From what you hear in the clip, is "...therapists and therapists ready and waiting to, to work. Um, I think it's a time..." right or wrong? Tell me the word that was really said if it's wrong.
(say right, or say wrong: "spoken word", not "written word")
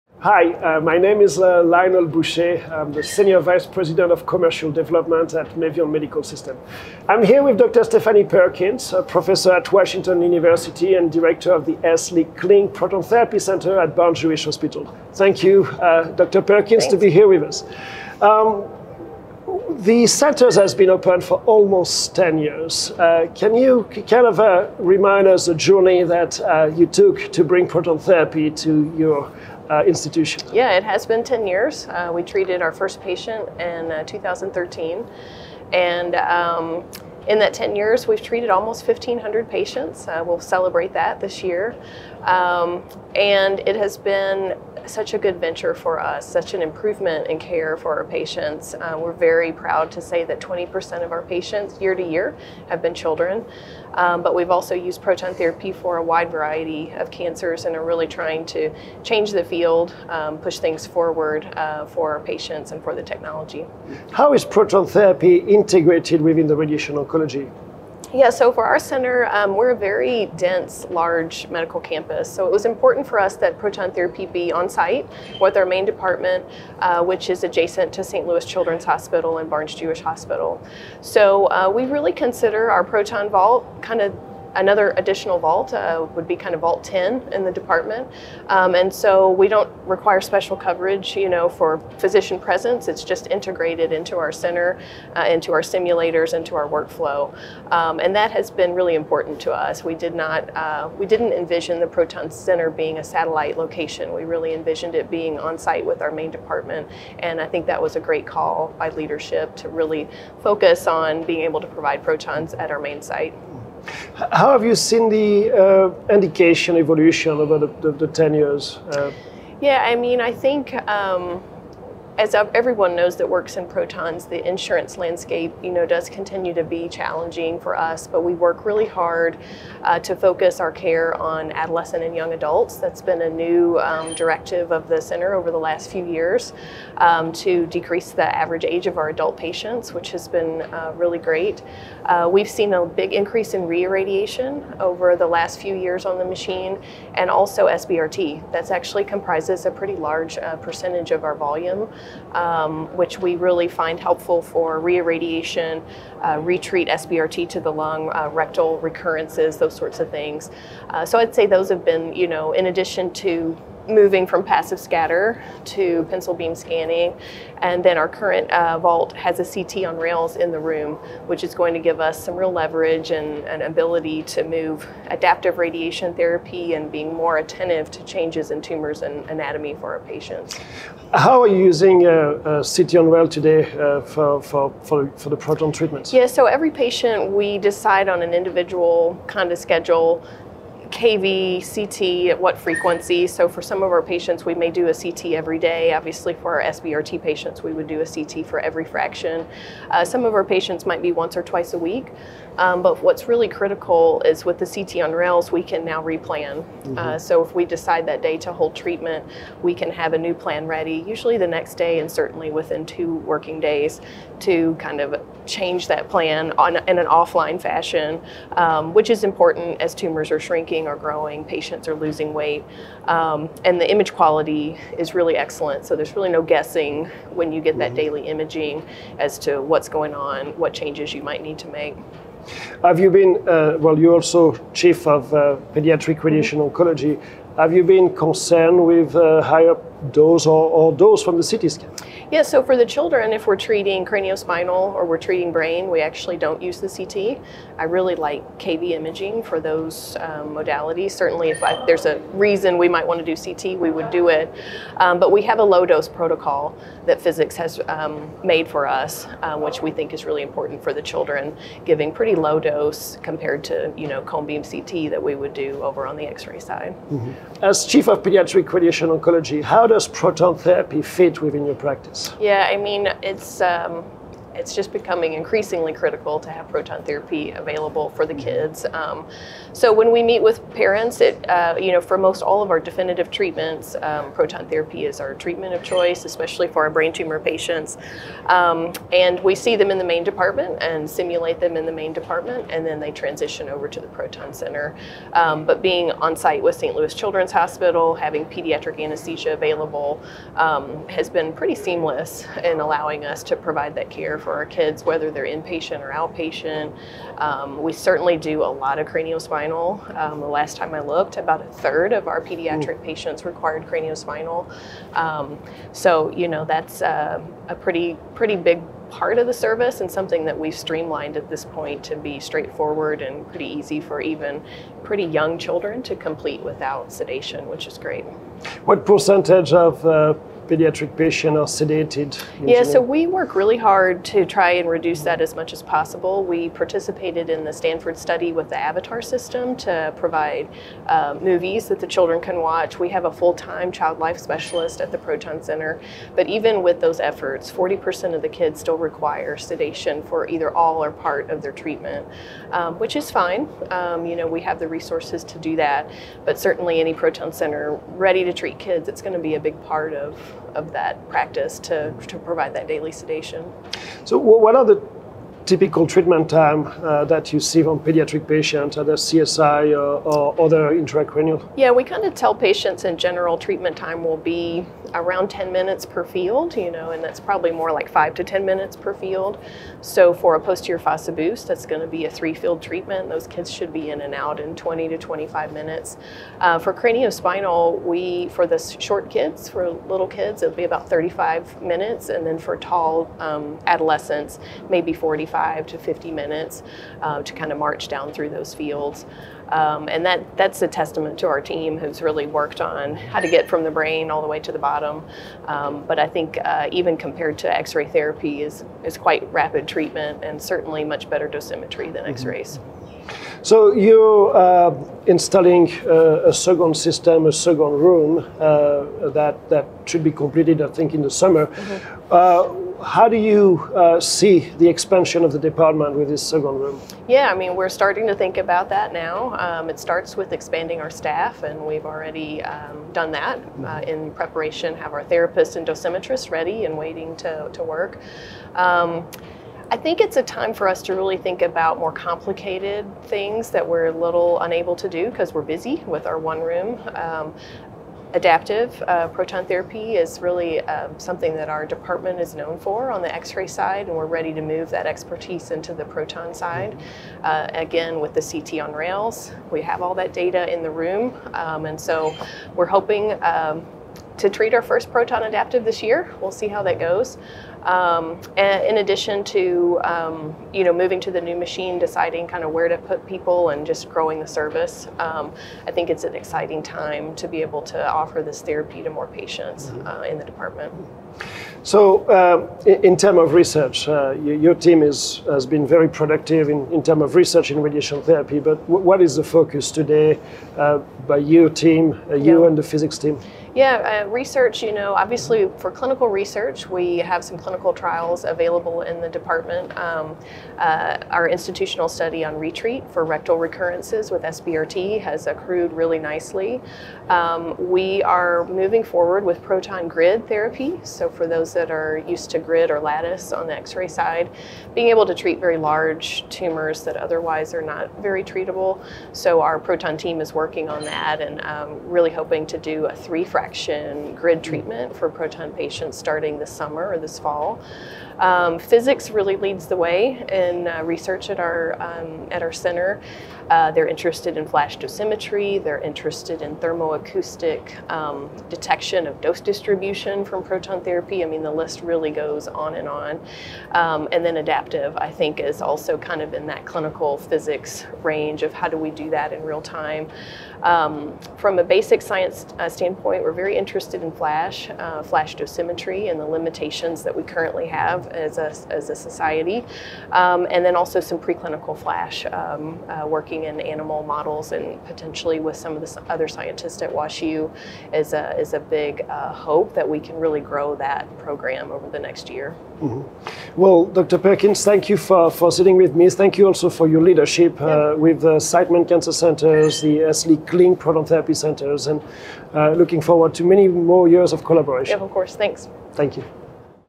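wrong: "dosimetrists", not "therapists".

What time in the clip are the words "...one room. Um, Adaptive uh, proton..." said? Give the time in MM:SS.
07:26.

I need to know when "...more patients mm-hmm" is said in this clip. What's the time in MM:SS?
07:59.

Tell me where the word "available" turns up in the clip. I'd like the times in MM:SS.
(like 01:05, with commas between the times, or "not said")
04:37, 04:59, 08:18.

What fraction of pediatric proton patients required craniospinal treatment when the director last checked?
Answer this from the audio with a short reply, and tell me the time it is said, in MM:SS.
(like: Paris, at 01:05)
a third, at 05:11.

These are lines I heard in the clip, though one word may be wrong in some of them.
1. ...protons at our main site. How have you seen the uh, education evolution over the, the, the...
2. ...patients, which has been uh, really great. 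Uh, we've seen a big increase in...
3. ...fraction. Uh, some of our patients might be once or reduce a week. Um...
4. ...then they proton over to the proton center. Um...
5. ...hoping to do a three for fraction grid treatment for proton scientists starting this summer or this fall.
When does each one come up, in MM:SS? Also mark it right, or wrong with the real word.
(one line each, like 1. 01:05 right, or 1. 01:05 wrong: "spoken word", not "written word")
1. 01:52 right
2. 02:19 right
3. 03:18 wrong: "twice", not "reduce"
4. 04:52 wrong: "transition", not "proton"
5. 08:42 wrong: "patients", not "scientists".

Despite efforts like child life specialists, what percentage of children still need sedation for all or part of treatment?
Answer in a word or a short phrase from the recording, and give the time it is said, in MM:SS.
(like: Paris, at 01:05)
40%, at 05:47.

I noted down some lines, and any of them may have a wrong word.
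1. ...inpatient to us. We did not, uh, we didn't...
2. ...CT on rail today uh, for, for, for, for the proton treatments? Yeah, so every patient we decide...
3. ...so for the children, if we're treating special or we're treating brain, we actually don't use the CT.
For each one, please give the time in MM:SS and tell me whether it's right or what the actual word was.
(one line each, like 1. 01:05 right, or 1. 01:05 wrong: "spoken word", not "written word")
1. 01:38 wrong: "important", not "inpatient"
2. 03:02 right
3. 04:02 wrong: "craniospinal", not "special".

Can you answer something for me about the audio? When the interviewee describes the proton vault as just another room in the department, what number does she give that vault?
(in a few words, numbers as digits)
10.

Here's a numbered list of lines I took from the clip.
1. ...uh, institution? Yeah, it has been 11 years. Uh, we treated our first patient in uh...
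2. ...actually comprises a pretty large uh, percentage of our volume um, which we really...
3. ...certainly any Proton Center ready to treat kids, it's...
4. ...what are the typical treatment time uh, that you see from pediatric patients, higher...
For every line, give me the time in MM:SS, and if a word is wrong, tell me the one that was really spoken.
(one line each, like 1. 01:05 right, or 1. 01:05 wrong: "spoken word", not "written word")
1. 00:29 wrong: "10", not "11"
2. 02:28 right
3. 05:56 right
4. 06:04 wrong: "either", not "higher".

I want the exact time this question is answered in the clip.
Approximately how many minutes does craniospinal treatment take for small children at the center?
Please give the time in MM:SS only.
06:31.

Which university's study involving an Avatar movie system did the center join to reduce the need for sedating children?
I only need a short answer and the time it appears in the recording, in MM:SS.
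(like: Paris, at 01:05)
Stanford, at 05:37.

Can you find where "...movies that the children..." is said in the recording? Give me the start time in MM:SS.
05:41.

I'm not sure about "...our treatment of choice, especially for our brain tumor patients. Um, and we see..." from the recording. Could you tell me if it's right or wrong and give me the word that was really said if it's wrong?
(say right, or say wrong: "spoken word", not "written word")
right.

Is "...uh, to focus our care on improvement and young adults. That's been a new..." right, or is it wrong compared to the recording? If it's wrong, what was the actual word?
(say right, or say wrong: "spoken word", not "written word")
wrong: "adolescent", not "improvement".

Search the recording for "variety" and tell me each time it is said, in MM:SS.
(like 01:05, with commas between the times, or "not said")
00:56.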